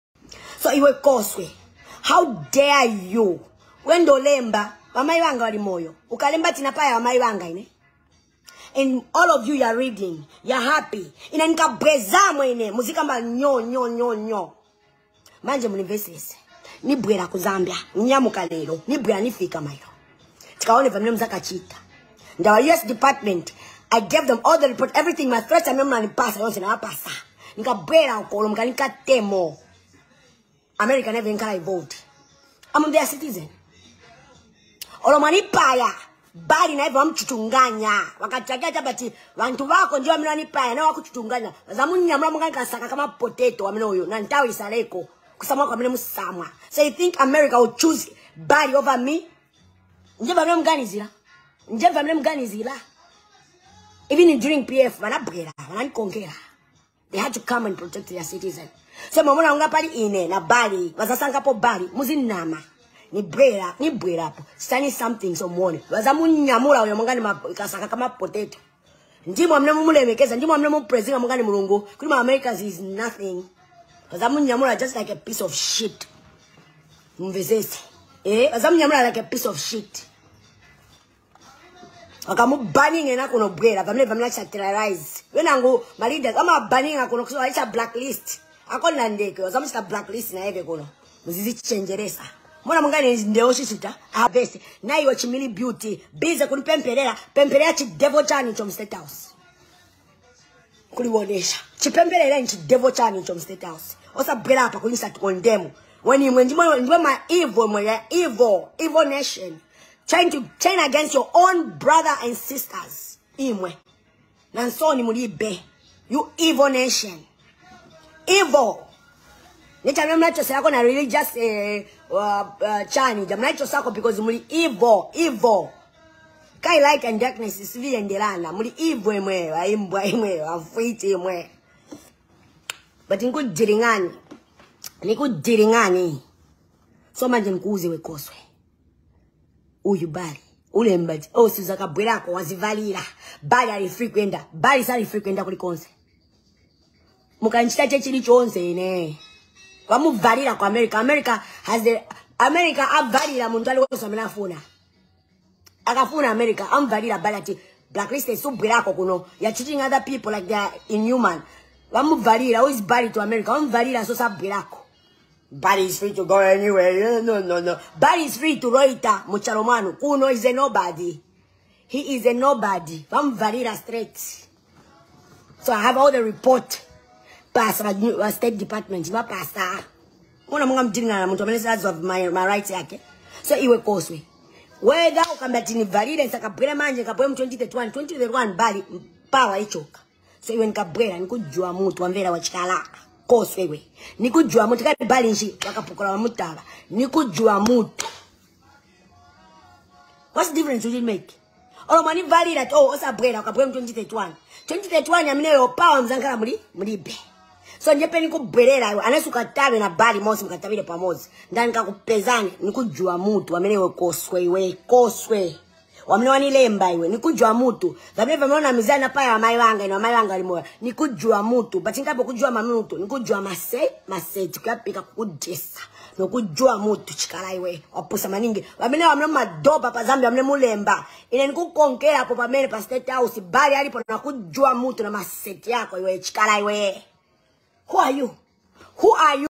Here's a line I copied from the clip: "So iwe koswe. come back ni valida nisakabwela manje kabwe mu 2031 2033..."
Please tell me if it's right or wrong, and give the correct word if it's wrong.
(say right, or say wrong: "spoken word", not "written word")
wrong: "2031", not "2033".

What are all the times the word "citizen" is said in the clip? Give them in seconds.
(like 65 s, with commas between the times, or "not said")
33 s, 58 s.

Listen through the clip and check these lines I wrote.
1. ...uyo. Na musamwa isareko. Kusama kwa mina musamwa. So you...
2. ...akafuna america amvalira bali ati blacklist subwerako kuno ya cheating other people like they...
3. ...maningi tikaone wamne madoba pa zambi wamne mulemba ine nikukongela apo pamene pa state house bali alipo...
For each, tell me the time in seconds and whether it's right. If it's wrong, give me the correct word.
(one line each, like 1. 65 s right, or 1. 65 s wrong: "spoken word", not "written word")
1. 43 s wrong: "ntawa", not "musamwa"
2. 155 s right
3. 228 s wrong: "wamene", not "tikaone".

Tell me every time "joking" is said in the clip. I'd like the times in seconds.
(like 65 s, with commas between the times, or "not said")
not said.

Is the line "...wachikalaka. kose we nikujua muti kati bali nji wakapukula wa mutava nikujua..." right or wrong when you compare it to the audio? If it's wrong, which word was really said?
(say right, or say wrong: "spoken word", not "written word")
right.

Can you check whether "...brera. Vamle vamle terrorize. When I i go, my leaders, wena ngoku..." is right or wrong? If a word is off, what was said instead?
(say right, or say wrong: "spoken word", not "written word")
right.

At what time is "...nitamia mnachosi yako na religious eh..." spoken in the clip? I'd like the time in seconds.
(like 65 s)
119 s.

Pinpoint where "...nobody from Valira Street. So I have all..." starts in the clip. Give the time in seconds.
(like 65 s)
172 s.